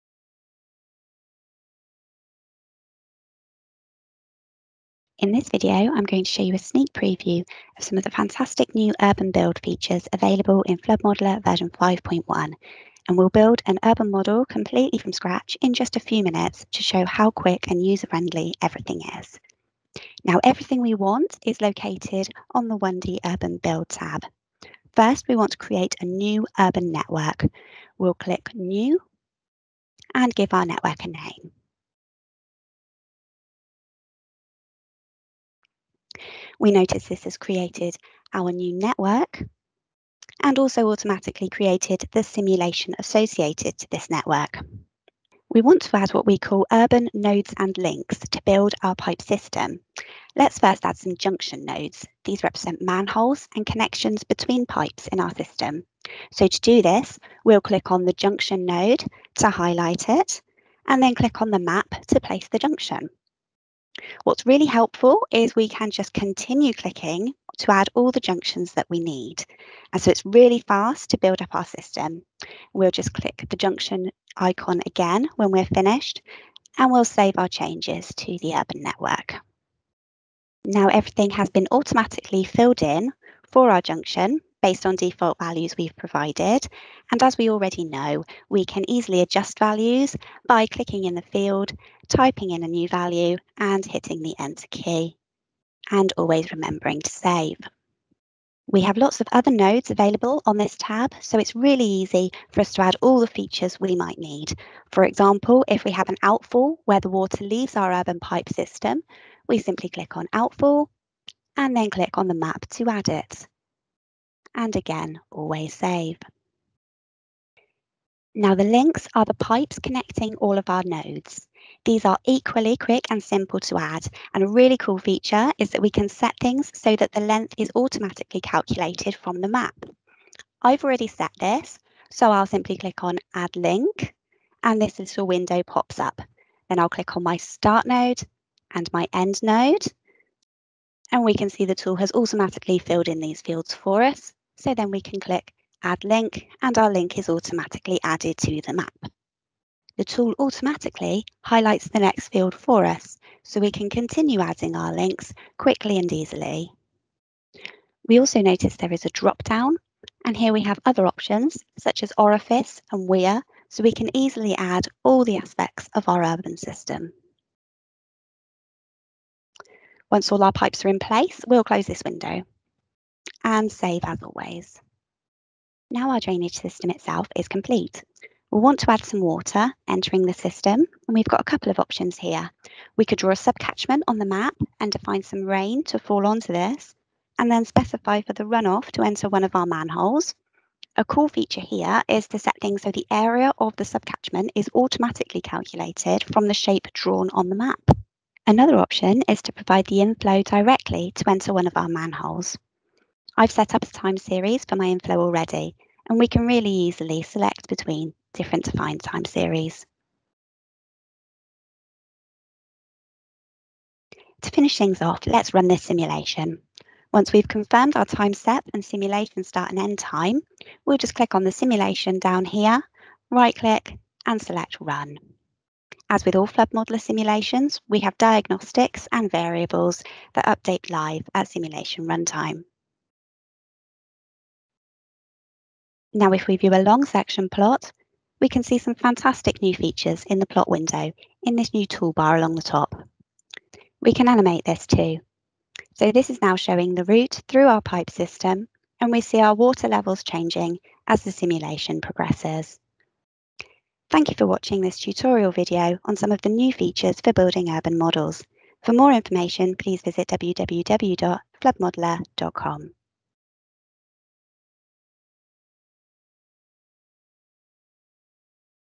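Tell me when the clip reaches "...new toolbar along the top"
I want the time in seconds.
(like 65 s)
241 s.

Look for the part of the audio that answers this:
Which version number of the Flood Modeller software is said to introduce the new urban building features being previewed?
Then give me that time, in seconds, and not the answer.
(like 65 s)
11 s.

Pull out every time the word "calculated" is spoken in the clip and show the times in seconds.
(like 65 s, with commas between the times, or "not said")
128 s, 195 s.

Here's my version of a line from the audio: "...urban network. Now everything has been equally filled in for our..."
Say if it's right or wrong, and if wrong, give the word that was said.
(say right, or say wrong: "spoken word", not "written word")
wrong: "automatically", not "equally".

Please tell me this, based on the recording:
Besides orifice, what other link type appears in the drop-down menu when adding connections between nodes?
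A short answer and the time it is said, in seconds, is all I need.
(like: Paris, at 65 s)
Weir, at 163 s.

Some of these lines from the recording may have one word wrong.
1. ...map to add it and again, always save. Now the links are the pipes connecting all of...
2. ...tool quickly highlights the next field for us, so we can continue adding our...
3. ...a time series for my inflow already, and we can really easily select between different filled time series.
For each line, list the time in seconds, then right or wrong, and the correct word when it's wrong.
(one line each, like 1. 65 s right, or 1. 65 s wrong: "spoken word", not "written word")
1. 112 s right
2. 150 s wrong: "automatically", not "quickly"
3. 203 s wrong: "defined", not "filled".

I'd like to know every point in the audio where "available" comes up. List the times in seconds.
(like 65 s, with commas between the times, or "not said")
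10 s, 99 s.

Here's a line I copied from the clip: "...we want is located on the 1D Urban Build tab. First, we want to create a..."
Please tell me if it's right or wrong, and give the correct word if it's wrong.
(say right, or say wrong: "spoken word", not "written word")
right.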